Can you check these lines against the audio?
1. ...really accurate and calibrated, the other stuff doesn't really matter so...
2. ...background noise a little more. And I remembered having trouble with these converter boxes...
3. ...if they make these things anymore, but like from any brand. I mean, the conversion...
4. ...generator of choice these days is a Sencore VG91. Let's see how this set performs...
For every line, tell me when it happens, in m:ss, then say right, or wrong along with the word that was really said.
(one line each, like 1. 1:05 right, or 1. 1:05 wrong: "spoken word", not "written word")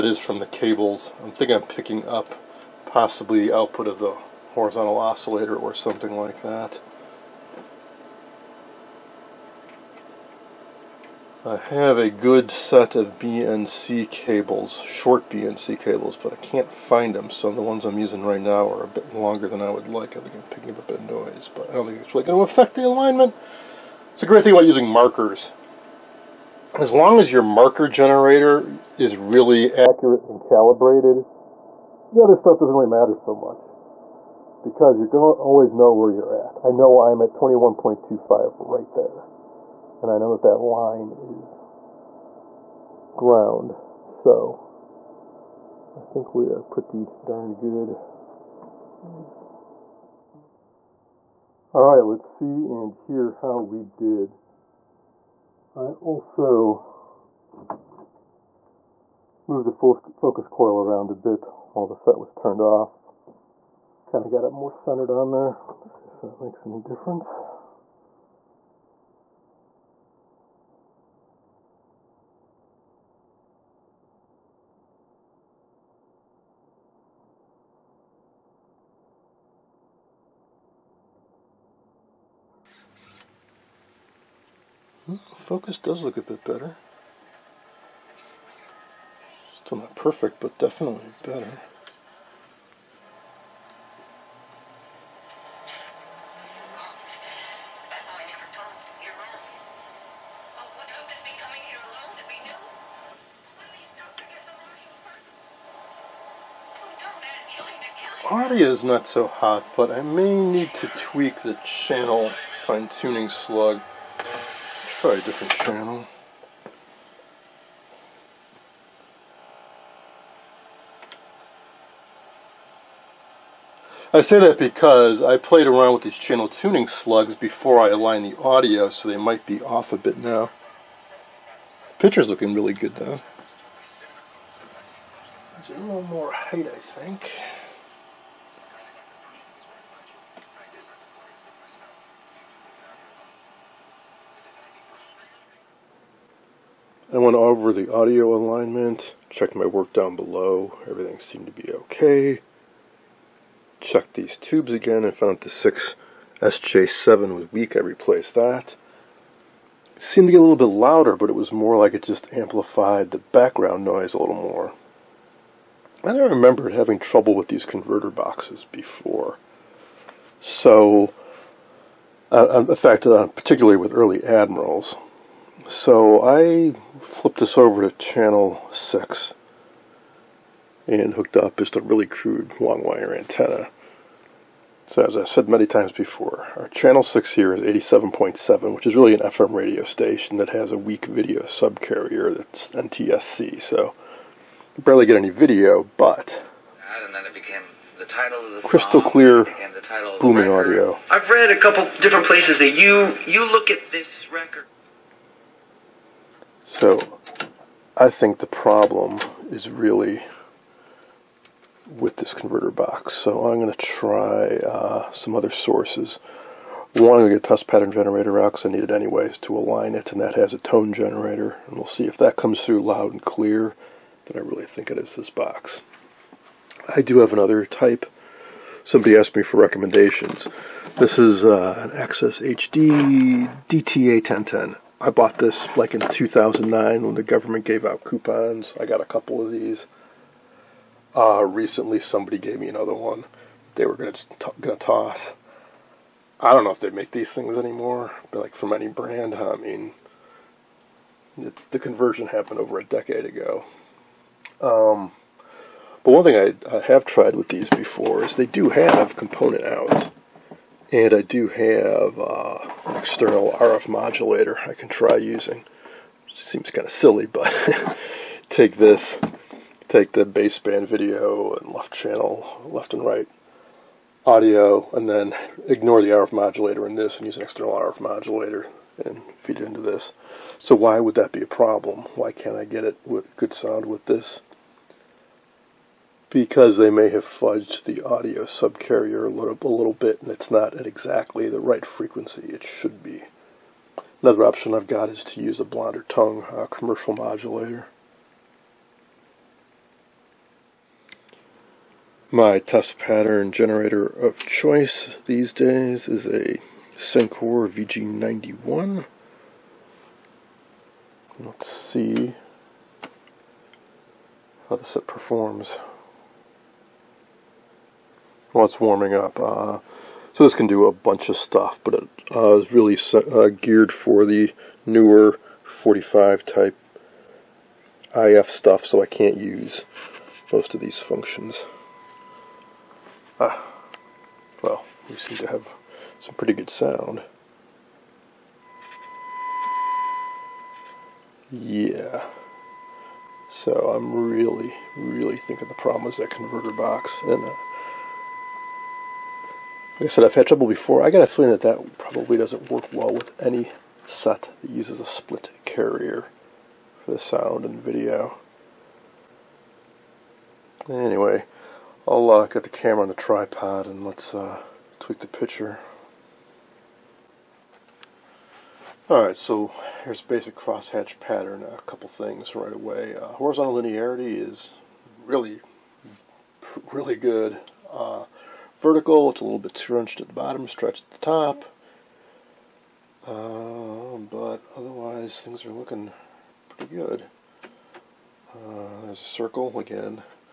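1. 0:29 right
2. 2:43 right
3. 4:06 right
4. 5:03 right.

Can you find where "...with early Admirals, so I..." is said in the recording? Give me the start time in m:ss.
2:53.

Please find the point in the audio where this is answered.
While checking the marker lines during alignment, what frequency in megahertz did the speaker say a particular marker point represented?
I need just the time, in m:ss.
0:37.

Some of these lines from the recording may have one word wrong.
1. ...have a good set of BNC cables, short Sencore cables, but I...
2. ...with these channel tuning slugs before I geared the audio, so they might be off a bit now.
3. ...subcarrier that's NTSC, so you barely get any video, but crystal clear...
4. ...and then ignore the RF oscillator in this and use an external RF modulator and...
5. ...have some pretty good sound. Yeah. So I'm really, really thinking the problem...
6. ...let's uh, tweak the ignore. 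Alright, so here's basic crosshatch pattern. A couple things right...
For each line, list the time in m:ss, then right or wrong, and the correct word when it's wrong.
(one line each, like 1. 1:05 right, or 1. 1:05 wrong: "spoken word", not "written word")
1. 0:11 wrong: "BNC", not "Sencore"
2. 2:05 wrong: "aligned", not "geared"
3. 3:11 right
4. 4:34 wrong: "modulator", not "oscillator"
5. 5:35 right
6. 6:04 wrong: "picture", not "ignore".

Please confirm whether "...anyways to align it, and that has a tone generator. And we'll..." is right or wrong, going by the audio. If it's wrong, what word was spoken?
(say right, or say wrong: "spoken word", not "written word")
right.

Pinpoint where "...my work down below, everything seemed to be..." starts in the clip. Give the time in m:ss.
2:29.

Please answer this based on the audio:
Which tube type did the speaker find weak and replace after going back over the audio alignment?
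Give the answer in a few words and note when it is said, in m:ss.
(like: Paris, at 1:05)
6SJ7, at 2:35.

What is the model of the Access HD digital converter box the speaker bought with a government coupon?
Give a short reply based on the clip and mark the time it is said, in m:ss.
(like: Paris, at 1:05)
DTA 1010, at 3:53.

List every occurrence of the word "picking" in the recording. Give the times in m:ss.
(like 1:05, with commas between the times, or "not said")
0:01, 0:20.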